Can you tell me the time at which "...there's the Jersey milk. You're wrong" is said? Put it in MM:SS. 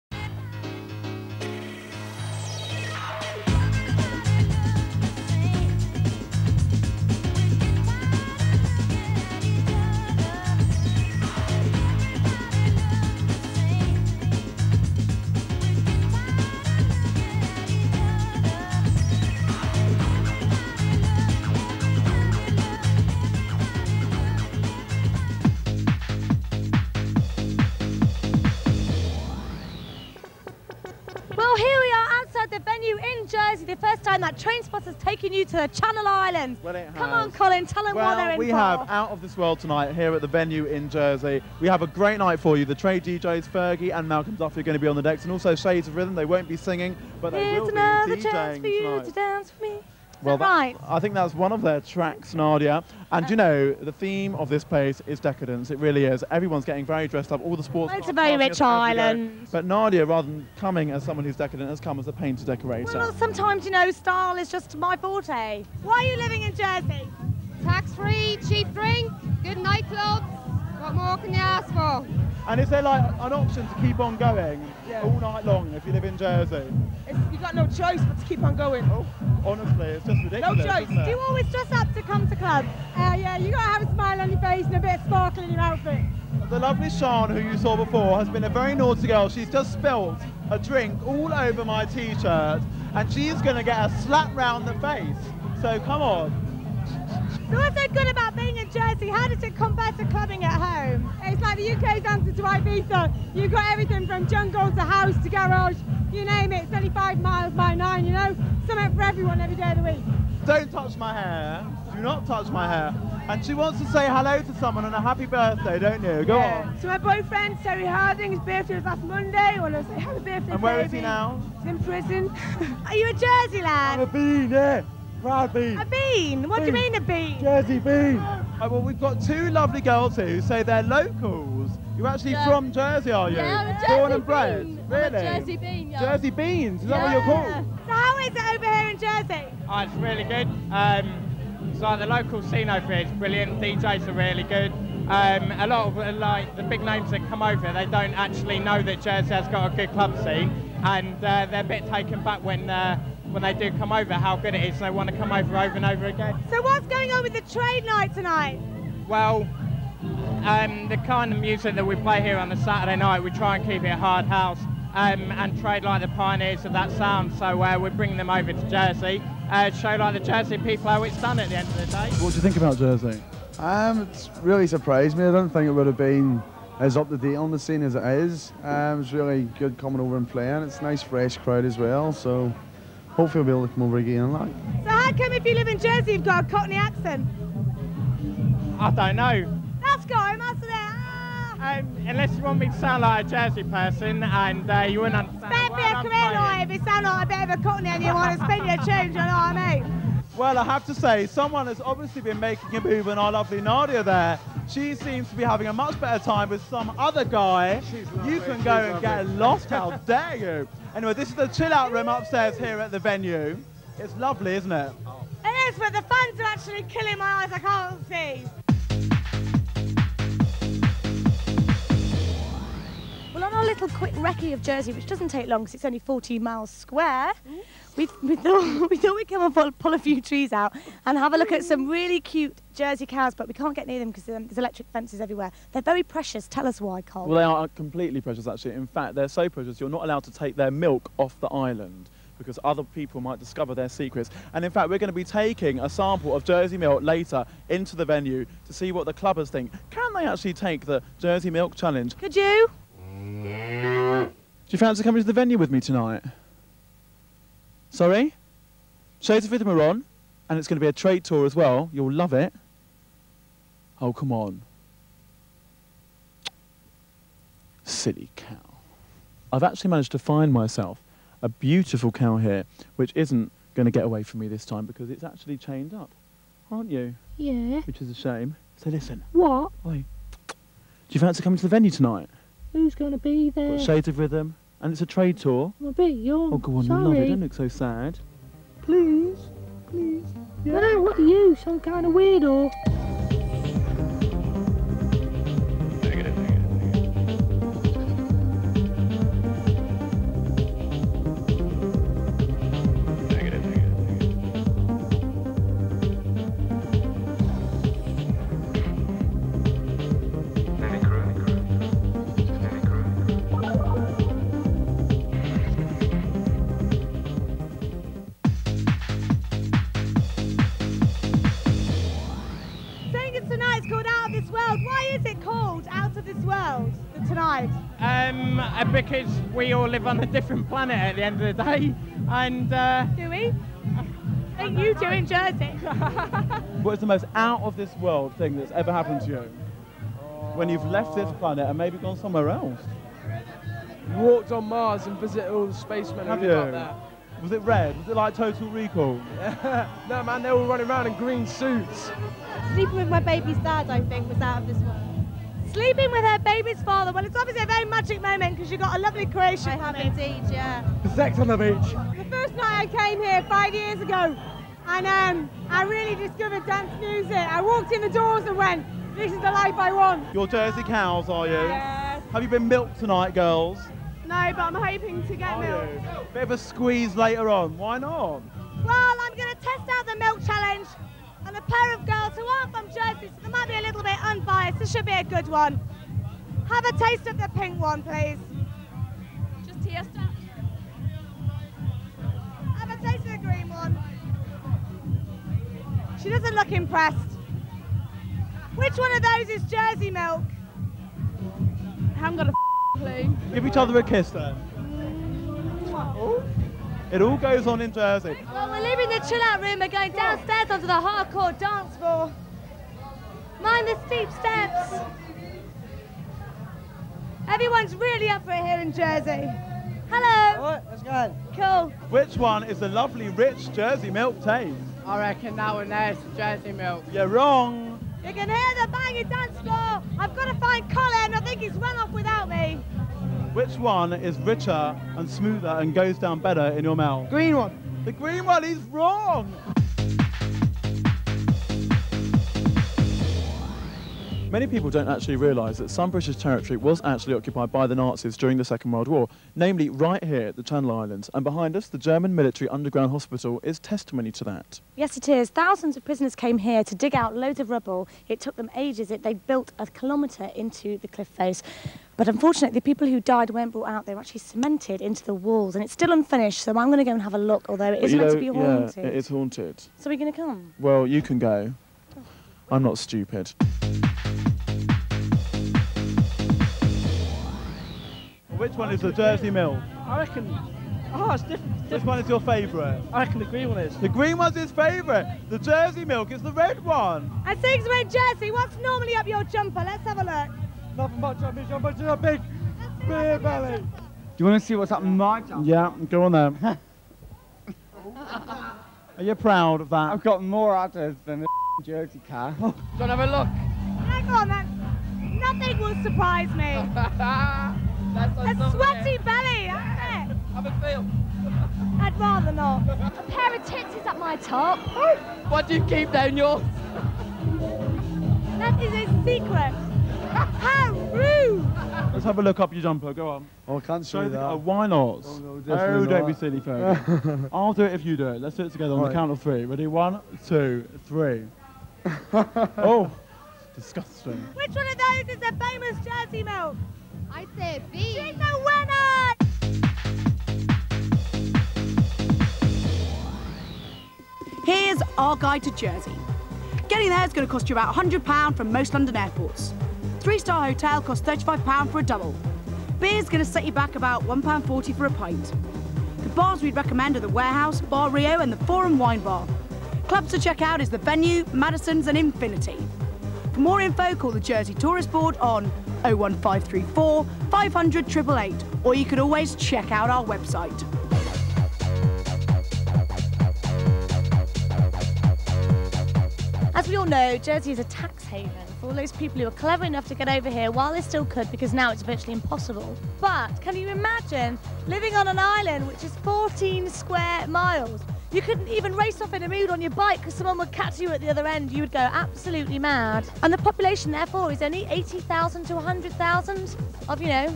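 07:05.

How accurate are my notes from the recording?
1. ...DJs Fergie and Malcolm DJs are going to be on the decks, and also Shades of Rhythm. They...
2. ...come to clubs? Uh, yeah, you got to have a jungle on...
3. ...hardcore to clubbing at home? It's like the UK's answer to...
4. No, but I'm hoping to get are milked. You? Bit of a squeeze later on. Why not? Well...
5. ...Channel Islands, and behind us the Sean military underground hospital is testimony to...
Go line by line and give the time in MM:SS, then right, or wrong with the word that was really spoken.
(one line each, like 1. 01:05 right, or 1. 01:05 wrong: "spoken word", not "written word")
1. 00:43 wrong: "Duffy", not "DJs"
2. 01:22 wrong: "smile", not "jungle"
3. 01:39 wrong: "compare", not "hardcore"
4. 06:14 right
5. 07:30 wrong: "German", not "Sean".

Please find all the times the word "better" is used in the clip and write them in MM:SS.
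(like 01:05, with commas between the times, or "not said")
03:15, 03:26, 07:16.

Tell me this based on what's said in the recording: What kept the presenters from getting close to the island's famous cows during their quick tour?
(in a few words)
Electric fences.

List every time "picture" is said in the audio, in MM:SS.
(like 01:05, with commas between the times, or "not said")
not said.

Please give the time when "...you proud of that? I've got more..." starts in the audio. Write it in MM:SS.
08:19.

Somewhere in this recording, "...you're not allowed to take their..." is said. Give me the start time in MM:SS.
03:59.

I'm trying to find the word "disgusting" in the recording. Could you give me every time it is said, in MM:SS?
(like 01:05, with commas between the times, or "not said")
08:53.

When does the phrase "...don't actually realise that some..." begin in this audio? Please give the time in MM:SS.
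07:24.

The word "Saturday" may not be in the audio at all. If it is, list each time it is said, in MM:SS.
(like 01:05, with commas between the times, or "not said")
02:42.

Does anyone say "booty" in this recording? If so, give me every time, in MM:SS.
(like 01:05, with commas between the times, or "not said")
not said.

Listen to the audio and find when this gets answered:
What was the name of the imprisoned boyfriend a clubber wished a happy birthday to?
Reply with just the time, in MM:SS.
01:57.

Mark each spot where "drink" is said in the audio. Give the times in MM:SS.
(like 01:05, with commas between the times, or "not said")
01:08, 01:30.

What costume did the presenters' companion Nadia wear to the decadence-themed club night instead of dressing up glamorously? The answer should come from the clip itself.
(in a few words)
Painter decorator.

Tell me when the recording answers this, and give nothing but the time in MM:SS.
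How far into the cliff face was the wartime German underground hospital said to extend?
07:39.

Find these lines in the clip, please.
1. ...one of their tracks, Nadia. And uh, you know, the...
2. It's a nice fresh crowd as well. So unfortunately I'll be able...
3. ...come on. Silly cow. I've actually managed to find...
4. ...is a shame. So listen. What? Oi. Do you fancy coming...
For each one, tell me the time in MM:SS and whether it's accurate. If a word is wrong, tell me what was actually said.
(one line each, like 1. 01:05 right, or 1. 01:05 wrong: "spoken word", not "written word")
1. 00:51 right
2. 03:00 wrong: "hopefully", not "unfortunately"
3. 04:24 right
4. 04:38 right.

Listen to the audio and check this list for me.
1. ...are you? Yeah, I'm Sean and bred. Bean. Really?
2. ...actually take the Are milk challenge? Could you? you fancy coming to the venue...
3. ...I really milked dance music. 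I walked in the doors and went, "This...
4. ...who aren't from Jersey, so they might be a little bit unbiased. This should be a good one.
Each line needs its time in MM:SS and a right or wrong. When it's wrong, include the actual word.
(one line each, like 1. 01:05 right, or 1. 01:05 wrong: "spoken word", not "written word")
1. 02:13 wrong: "Born", not "Sean"
2. 04:10 wrong: "Jersey", not "Are"
3. 06:05 wrong: "discovered", not "milked"
4. 06:22 right.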